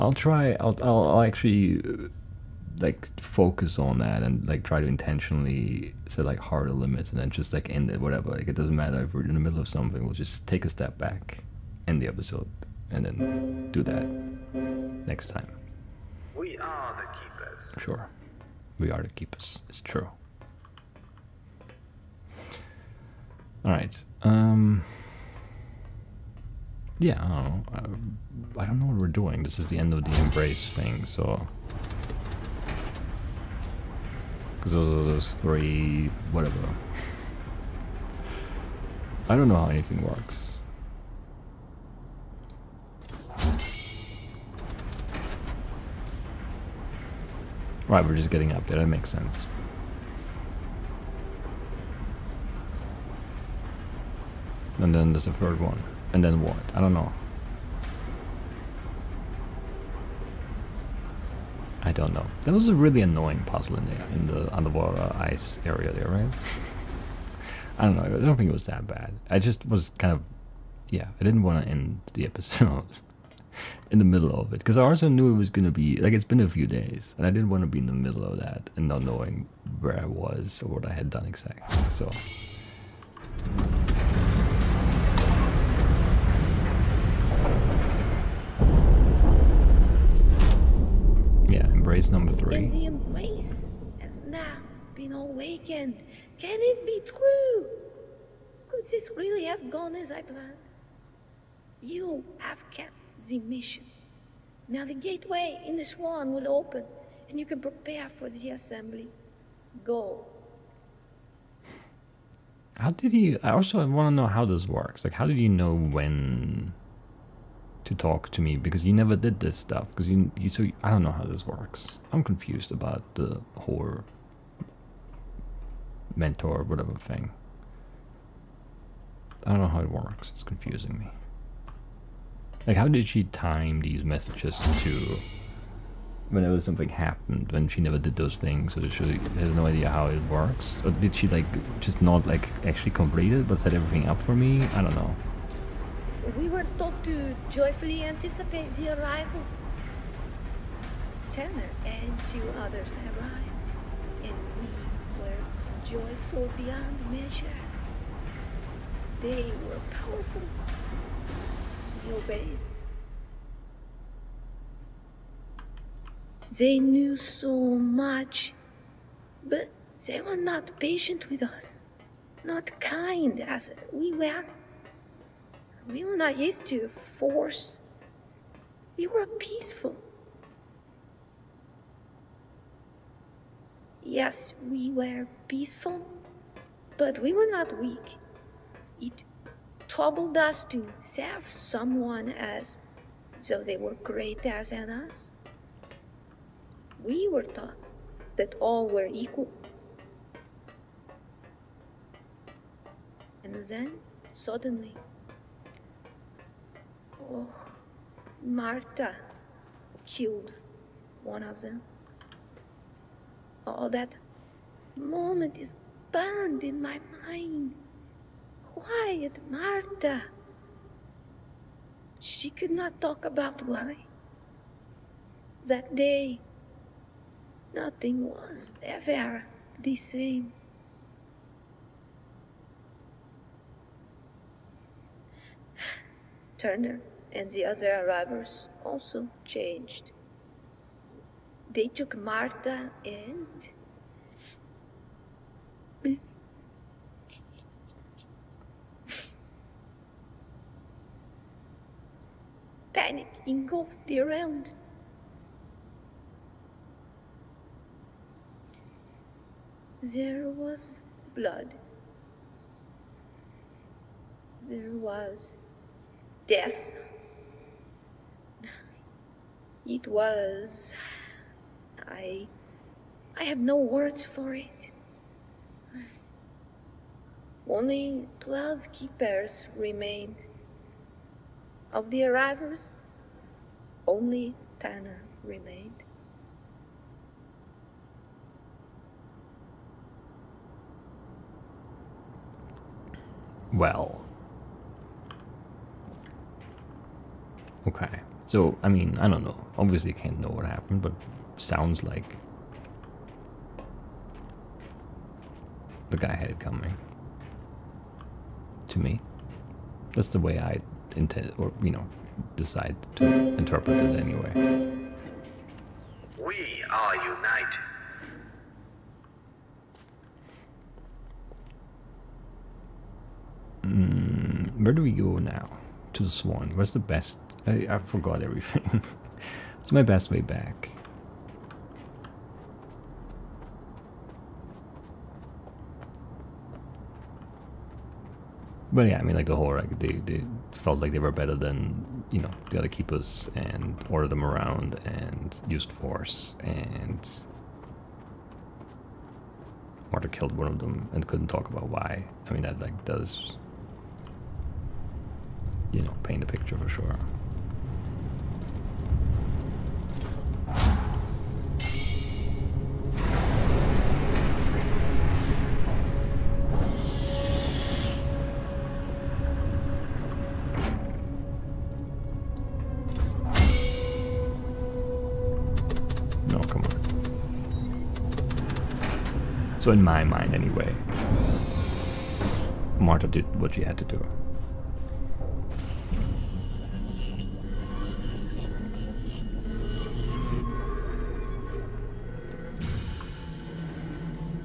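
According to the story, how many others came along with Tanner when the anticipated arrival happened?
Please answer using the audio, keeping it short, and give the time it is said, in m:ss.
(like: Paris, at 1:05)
2, at 2:32.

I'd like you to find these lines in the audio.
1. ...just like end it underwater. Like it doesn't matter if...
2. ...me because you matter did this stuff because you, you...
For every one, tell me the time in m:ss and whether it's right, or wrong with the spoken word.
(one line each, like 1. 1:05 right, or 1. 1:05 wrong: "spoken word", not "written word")
1. 0:07 wrong: "whatever", not "underwater"
2. 1:58 wrong: "never", not "matter".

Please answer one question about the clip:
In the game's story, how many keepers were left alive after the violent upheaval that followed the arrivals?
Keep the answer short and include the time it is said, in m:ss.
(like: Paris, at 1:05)
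12, at 4:38.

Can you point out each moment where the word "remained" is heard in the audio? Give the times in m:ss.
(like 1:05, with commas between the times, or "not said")
4:39, 4:45.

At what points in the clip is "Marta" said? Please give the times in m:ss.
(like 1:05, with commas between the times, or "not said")
3:28, 3:39, 4:02, 5:50, 6:22.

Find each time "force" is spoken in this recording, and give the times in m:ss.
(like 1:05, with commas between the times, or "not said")
2:56, 5:45.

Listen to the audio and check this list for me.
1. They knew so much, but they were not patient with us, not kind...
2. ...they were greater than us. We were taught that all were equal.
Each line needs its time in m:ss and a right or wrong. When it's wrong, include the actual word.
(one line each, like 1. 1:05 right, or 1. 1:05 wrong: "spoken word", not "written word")
1. 2:46 right
2. 3:13 right.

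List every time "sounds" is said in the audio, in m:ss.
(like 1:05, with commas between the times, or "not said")
5:01.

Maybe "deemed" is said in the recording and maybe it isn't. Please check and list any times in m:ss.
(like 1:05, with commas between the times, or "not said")
not said.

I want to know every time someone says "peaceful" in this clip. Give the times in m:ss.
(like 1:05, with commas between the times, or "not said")
2:59, 3:05.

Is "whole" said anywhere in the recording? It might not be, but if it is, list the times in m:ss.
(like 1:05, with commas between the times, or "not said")
2:03, 5:39.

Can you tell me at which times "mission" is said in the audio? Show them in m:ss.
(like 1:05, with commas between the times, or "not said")
1:43.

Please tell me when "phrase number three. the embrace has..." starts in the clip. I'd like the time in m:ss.
1:31.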